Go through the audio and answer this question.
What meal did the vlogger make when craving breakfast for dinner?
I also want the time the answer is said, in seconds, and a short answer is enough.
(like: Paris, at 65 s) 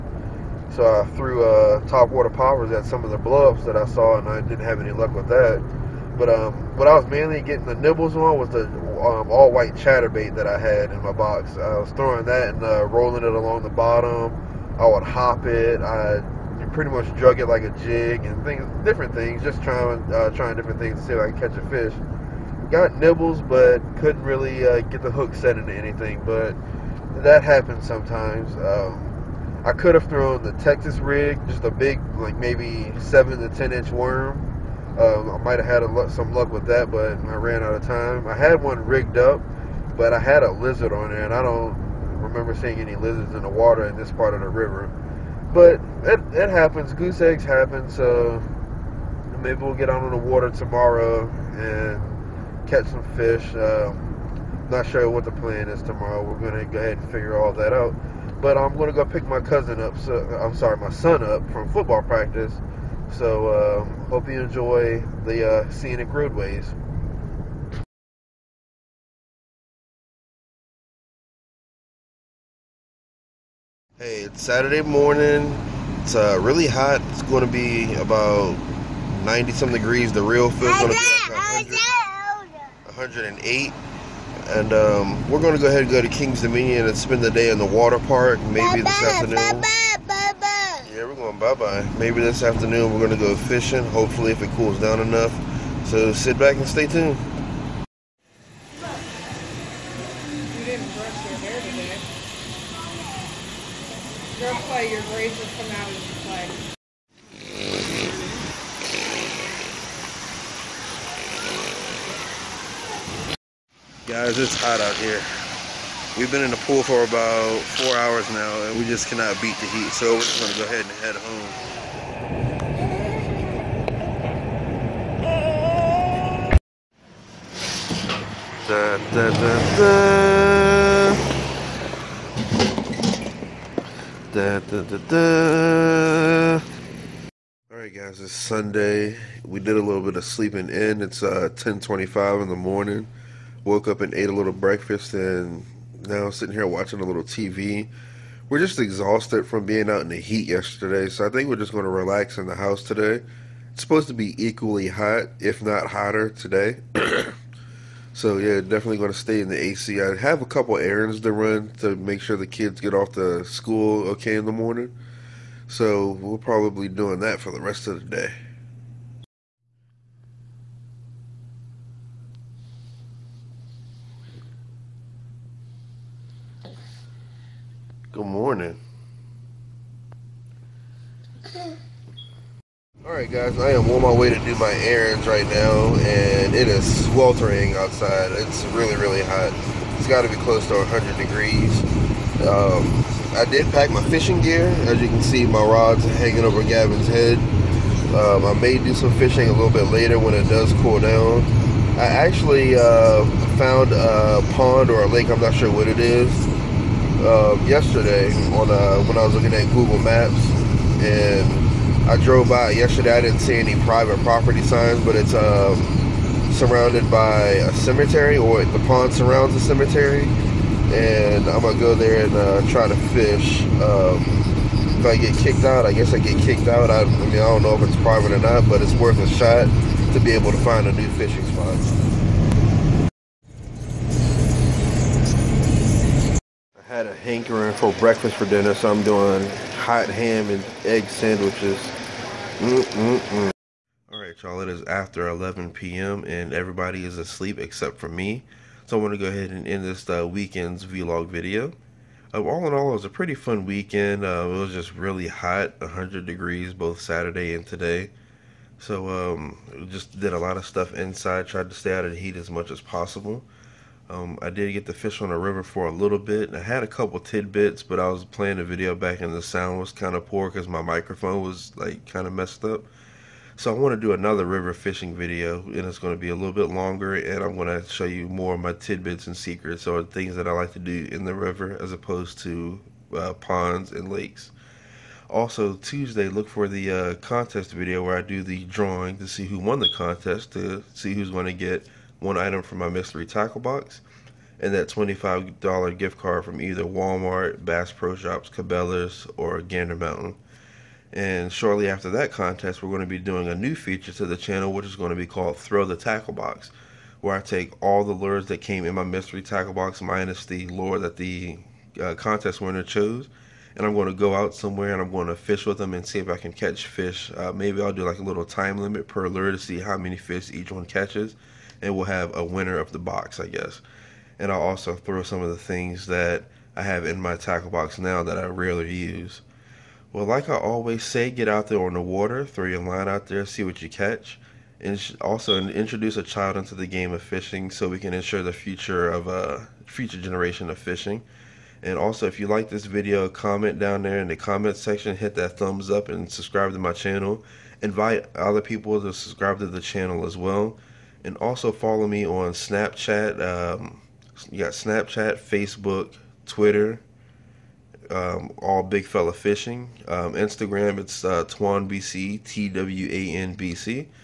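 Hot ham and egg sandwiches, at 239 s.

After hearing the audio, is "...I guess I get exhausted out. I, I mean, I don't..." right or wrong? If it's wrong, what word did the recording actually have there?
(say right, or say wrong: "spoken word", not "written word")
wrong: "kicked", not "exhausted".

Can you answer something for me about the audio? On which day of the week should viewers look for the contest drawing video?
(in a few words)
Tuesday.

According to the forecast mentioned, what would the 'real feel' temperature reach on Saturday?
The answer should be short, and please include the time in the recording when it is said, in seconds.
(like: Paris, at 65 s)
108, at 82 s.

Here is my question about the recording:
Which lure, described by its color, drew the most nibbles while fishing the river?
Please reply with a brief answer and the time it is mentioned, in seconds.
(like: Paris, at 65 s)
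All white chatterbait, at 9 s.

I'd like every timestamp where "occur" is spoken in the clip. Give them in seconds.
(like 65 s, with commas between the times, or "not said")
not said.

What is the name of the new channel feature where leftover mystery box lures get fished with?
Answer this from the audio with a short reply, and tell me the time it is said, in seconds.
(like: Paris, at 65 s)
Throw the Tackle Box, at 305 s.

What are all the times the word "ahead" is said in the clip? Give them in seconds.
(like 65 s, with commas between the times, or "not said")
56 s, 85 s, 120 s, 249 s.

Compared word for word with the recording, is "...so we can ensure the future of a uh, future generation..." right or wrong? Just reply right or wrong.
right.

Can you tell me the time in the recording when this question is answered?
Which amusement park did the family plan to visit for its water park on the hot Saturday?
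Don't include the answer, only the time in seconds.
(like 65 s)
86 s.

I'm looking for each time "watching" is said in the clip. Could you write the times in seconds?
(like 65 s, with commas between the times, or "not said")
146 s.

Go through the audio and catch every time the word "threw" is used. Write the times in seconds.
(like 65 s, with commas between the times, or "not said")
1 s.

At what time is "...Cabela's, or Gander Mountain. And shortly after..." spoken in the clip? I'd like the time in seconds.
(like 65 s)
298 s.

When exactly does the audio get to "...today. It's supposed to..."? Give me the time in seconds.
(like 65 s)
152 s.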